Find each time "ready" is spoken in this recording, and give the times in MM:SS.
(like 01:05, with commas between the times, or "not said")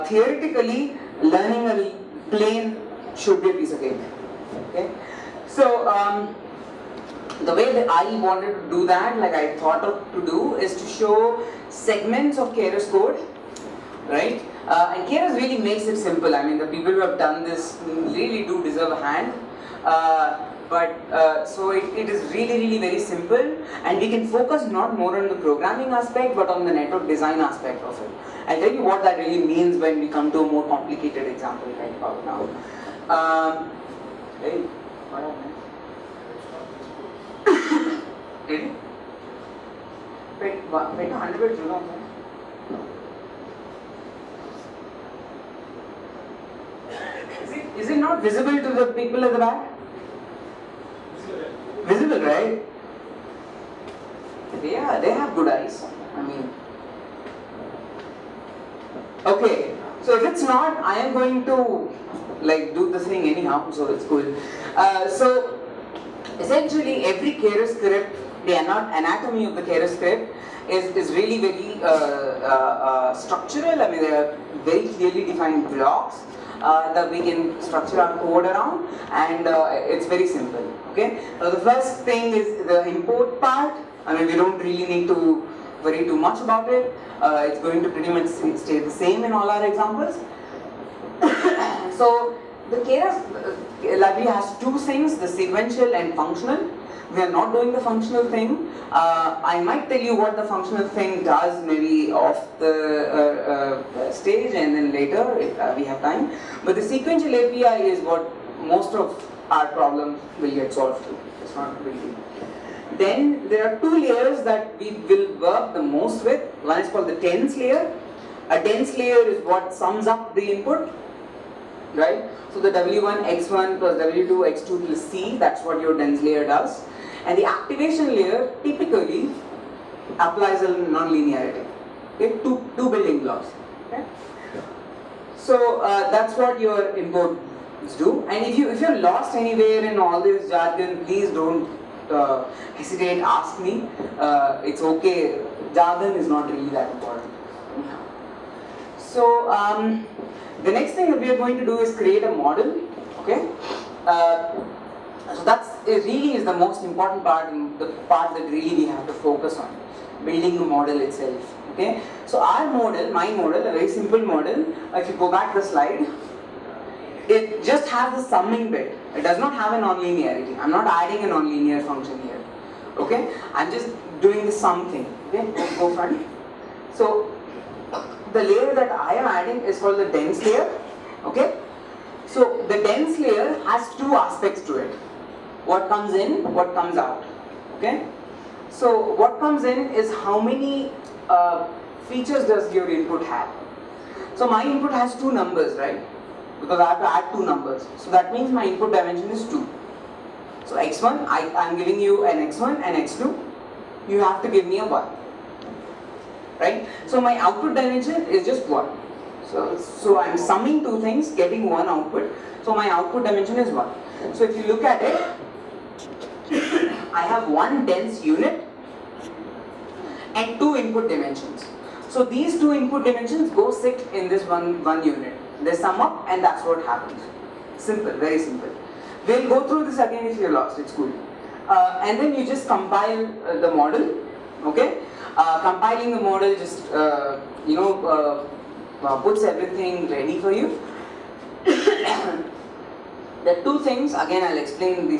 00:38, 04:00.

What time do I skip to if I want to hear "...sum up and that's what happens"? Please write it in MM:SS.
03:45.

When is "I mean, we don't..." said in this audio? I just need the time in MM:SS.
01:24.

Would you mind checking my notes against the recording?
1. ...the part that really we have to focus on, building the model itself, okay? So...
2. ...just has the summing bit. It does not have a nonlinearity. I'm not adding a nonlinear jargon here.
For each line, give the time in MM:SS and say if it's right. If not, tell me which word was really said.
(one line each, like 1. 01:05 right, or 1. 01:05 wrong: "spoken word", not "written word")
1. 02:37 right
2. 02:47 wrong: "function", not "jargon".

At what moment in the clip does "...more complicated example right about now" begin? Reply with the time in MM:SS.
00:30.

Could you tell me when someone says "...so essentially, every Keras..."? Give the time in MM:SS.
01:05.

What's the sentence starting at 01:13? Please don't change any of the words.
I mean, they are very clearly defined blocks uh, that we can structure our code around and uh, it's very simple.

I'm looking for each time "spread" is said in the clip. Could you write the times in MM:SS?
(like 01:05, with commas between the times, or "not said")
not said.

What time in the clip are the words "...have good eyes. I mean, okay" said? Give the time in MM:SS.
00:55.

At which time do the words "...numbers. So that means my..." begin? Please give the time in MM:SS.
03:17.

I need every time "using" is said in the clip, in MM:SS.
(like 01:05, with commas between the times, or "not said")
not said.